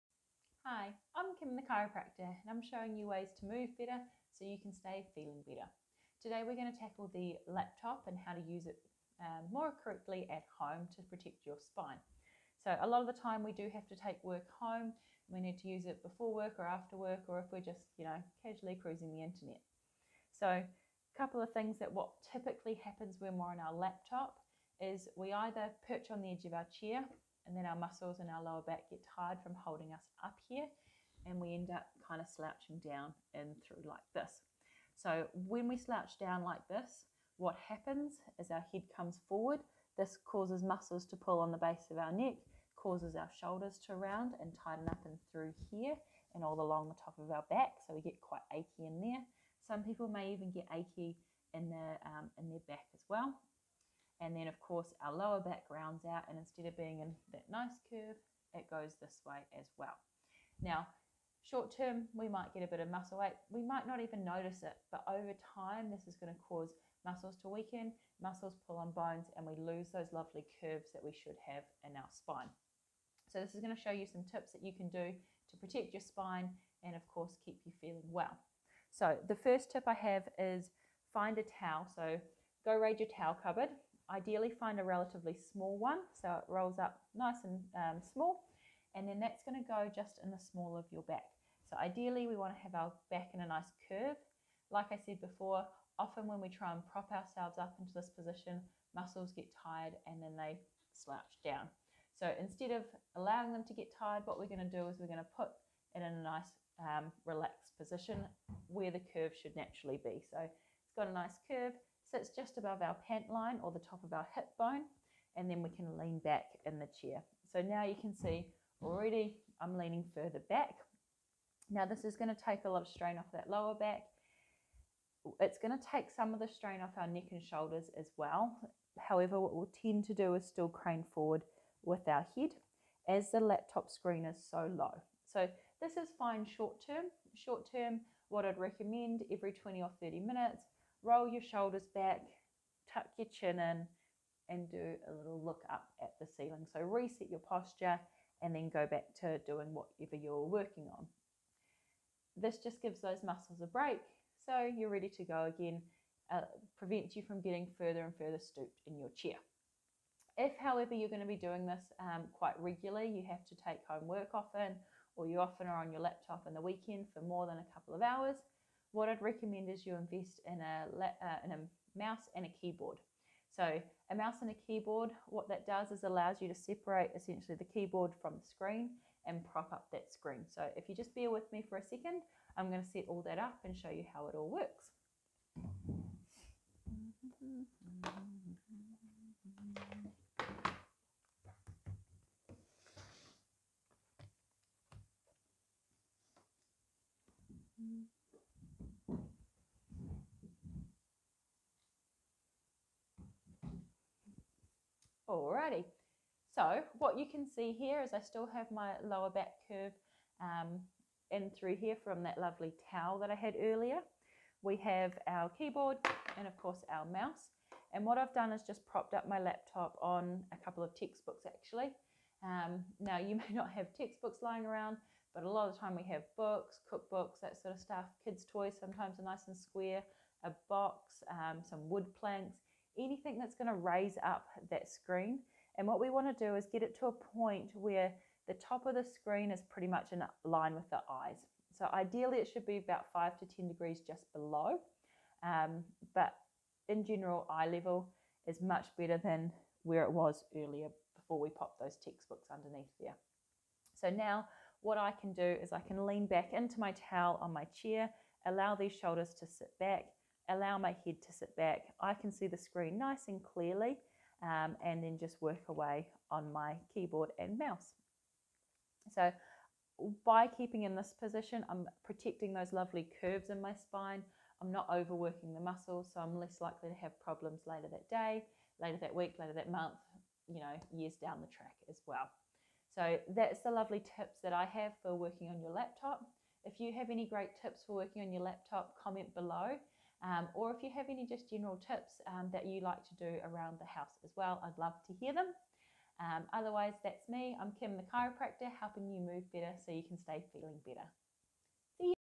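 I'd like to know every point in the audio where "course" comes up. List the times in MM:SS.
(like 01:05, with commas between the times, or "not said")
00:54, 01:17, 03:36.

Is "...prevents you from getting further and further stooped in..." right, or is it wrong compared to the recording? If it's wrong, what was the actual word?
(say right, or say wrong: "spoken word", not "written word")
right.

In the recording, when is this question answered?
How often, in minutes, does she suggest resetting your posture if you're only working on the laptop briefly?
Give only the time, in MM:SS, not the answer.
02:19.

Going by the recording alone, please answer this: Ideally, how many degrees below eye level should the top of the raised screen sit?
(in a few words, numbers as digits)
5 to 10 degrees.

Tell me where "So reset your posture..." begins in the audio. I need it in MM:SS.
02:26.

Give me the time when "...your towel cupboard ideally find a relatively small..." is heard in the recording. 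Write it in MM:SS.
01:22.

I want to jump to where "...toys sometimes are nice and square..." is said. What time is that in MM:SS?
03:48.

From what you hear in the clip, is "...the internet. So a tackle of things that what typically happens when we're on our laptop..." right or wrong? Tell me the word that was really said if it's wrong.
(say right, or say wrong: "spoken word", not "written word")
wrong: "couple", not "tackle".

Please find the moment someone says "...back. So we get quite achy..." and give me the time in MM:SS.
00:47.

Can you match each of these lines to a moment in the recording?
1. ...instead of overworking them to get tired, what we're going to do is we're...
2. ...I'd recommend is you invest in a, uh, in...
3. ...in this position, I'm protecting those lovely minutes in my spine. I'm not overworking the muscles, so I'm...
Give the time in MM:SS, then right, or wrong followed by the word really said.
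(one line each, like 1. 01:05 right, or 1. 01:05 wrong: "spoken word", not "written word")
1. 01:42 wrong: "allowing", not "overworking"
2. 02:49 right
3. 04:30 wrong: "curves", not "minutes".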